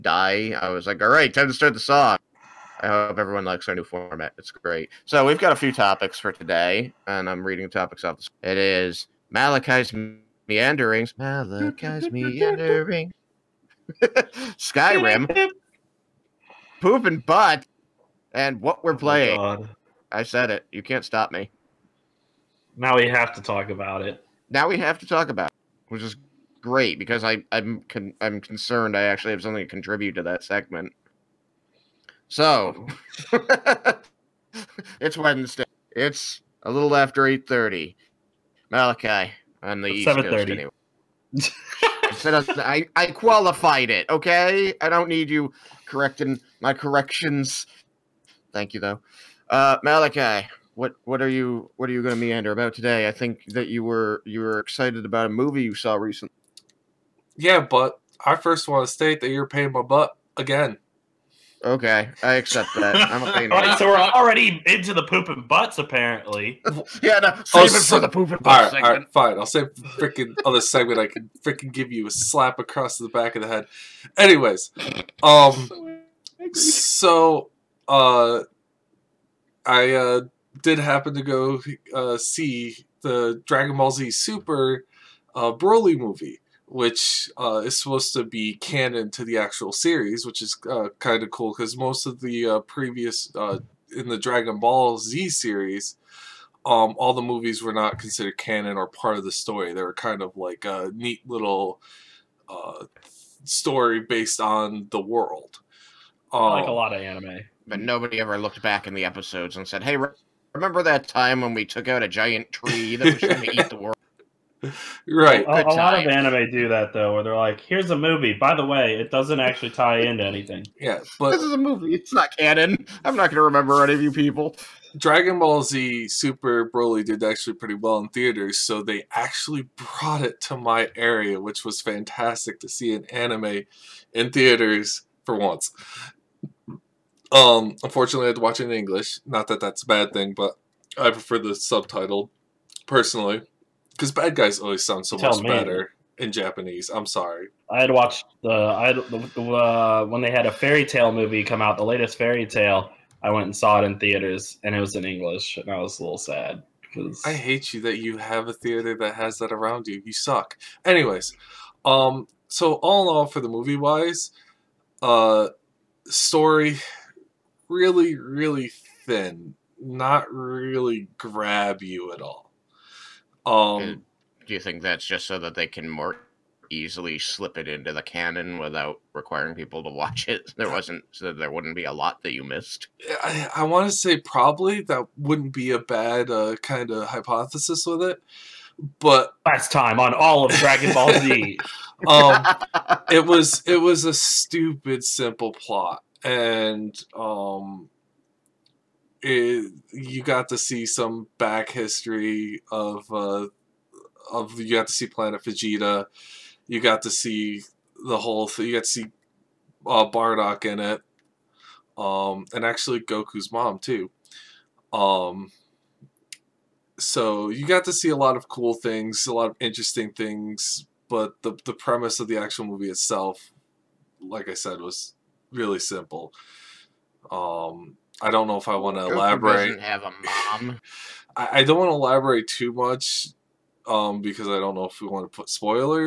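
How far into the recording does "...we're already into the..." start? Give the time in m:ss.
1:03.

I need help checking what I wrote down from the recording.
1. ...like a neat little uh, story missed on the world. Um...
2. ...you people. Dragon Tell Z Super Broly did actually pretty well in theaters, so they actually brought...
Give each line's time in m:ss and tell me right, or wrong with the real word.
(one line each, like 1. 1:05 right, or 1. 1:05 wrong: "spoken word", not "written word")
1. 1:40 wrong: "based", not "missed"
2. 2:04 wrong: "Ball", not "Tell".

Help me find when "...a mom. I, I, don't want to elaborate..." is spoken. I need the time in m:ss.
3:50.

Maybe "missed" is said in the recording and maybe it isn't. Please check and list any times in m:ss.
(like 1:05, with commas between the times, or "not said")
3:02.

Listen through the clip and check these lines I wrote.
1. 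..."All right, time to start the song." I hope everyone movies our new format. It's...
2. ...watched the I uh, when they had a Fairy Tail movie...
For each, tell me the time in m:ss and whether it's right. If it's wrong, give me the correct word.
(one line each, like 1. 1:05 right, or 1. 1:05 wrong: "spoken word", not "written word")
1. 0:01 wrong: "likes", not "movies"
2. 2:27 right.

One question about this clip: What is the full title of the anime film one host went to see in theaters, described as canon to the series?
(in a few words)
Dragon Ball Z Super Broly.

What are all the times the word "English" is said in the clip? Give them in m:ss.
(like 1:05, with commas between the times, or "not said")
2:18, 2:35.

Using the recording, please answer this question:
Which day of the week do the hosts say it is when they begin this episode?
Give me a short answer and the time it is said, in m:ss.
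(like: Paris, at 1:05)
Wednesday, at 0:35.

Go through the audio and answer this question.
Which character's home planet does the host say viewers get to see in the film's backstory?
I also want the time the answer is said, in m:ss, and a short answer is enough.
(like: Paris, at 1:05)
Planet Vegeta, at 3:25.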